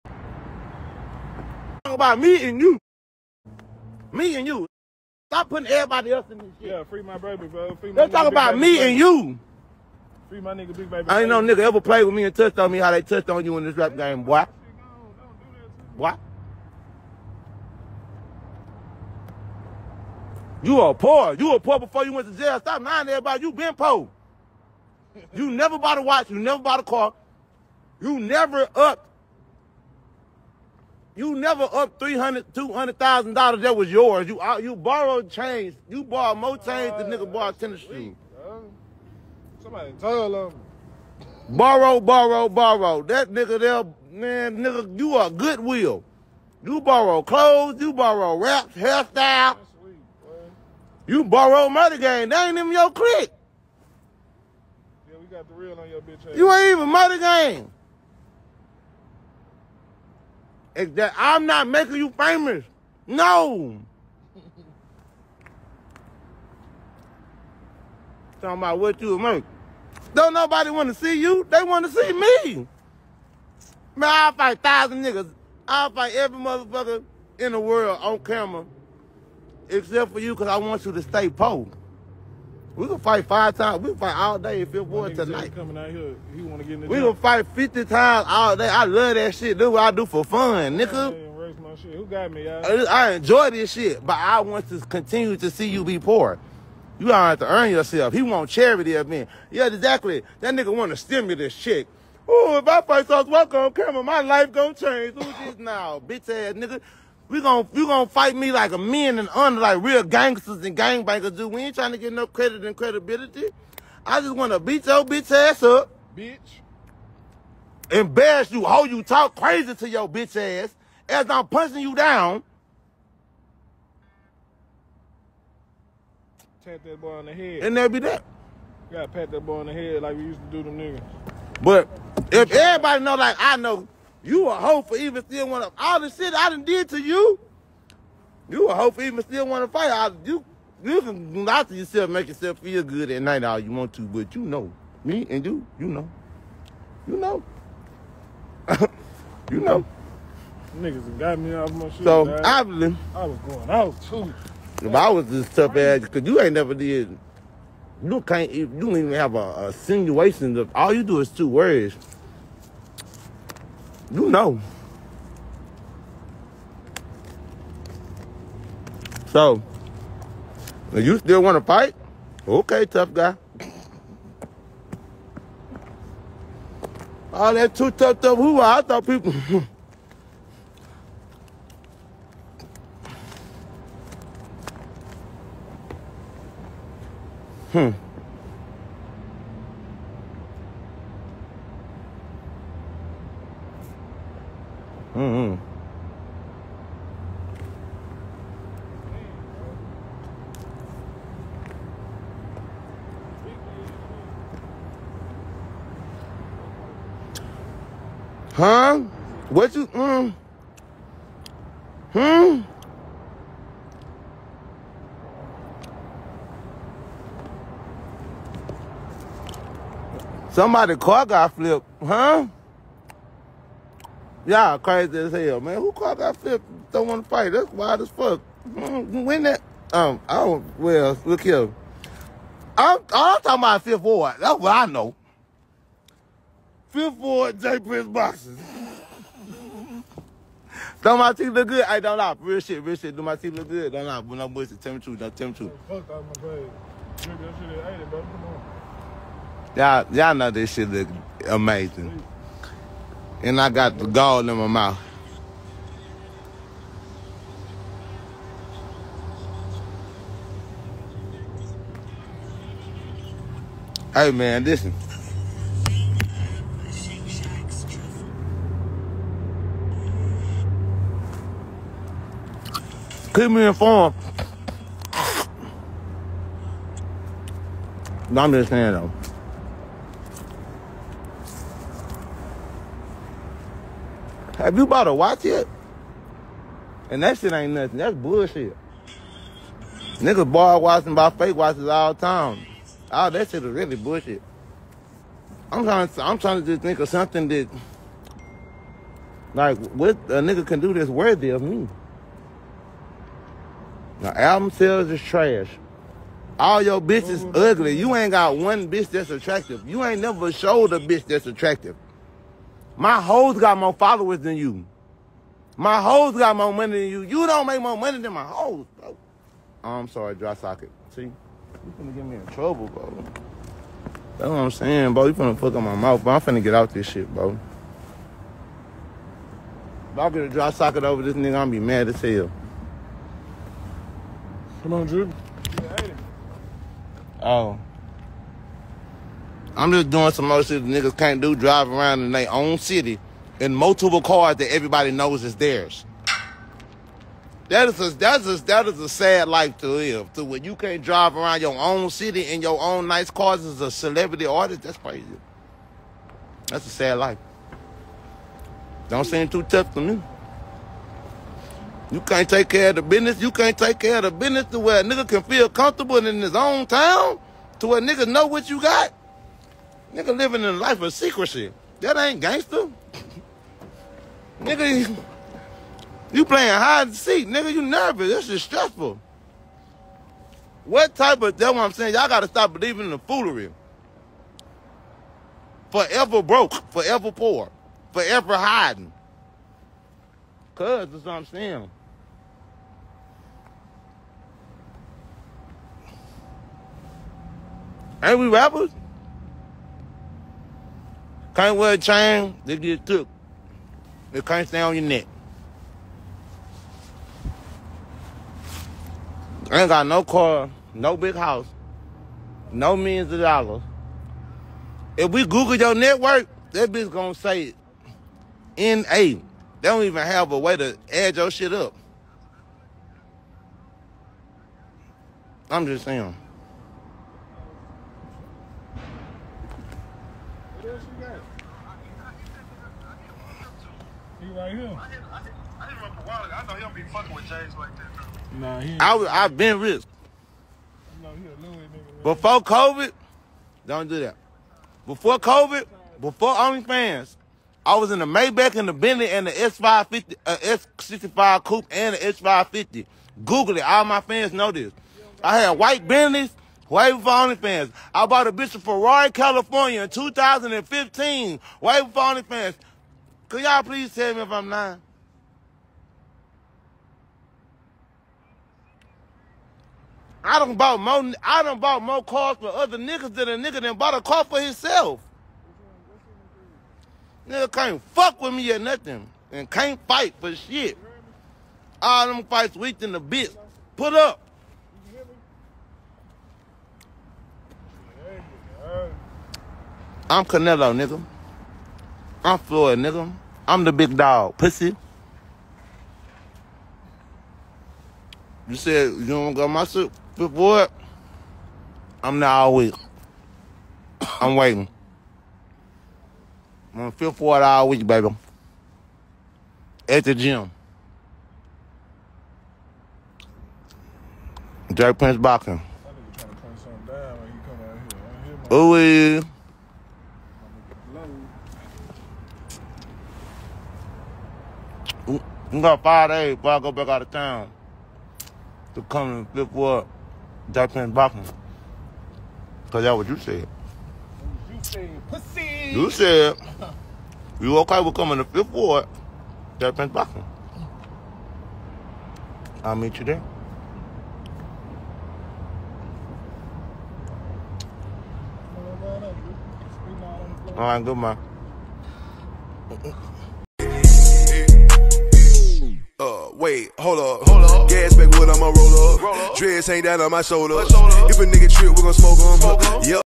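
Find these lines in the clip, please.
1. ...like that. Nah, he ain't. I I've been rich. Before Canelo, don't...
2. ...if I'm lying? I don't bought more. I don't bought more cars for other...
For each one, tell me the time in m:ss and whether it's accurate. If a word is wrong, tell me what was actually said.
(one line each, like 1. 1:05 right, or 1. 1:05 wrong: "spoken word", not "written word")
1. 7:17 wrong: "COVID", not "Canelo"
2. 7:44 right.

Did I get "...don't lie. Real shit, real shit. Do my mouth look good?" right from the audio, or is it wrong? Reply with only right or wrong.
wrong.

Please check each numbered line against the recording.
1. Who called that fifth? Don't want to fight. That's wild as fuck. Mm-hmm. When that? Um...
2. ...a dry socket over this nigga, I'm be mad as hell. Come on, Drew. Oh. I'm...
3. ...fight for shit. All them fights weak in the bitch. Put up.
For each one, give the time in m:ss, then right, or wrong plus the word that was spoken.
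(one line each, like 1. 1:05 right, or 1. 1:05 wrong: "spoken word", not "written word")
1. 3:45 right
2. 5:30 right
3. 8:00 right.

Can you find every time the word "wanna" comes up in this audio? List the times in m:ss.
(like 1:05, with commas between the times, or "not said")
1:26, 1:54.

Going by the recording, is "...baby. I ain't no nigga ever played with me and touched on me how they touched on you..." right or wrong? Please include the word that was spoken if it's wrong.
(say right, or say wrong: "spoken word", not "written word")
right.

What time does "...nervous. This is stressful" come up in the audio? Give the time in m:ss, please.
6:17.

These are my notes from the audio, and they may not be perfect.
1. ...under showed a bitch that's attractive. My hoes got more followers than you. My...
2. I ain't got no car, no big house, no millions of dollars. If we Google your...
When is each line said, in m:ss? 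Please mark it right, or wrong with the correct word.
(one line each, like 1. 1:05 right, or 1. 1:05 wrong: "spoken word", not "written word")
1. 5:10 wrong: "never", not "under"
2. 6:49 right.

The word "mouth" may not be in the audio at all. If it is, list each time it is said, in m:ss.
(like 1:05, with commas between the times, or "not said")
4:14, 5:25.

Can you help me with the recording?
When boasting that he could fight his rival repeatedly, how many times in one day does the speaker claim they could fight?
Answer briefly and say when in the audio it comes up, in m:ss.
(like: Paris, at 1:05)
50, at 1:27.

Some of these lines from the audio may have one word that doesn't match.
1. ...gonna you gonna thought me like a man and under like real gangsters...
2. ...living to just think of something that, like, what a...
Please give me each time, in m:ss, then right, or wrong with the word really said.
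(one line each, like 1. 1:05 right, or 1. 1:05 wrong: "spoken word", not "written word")
1. 1:47 wrong: "fight", not "thought"
2. 4:56 wrong: "trying", not "living".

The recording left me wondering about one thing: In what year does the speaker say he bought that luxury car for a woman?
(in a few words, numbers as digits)
2015.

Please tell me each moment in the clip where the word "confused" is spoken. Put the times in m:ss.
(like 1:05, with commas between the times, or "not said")
not said.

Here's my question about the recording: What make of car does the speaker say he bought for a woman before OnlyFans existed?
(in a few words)
Ferrari.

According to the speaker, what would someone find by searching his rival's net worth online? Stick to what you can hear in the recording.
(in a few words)
N/A.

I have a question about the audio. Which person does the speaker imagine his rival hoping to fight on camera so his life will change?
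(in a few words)
Sauce Walka.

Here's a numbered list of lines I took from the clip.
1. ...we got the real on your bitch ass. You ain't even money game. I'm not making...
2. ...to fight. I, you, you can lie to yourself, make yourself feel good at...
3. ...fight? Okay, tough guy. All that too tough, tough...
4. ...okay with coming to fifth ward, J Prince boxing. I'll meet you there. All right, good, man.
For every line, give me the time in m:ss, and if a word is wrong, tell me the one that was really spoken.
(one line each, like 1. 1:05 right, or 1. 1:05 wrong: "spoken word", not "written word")
1. 0:55 right
2. 2:19 right
3. 2:51 right
4. 8:57 right.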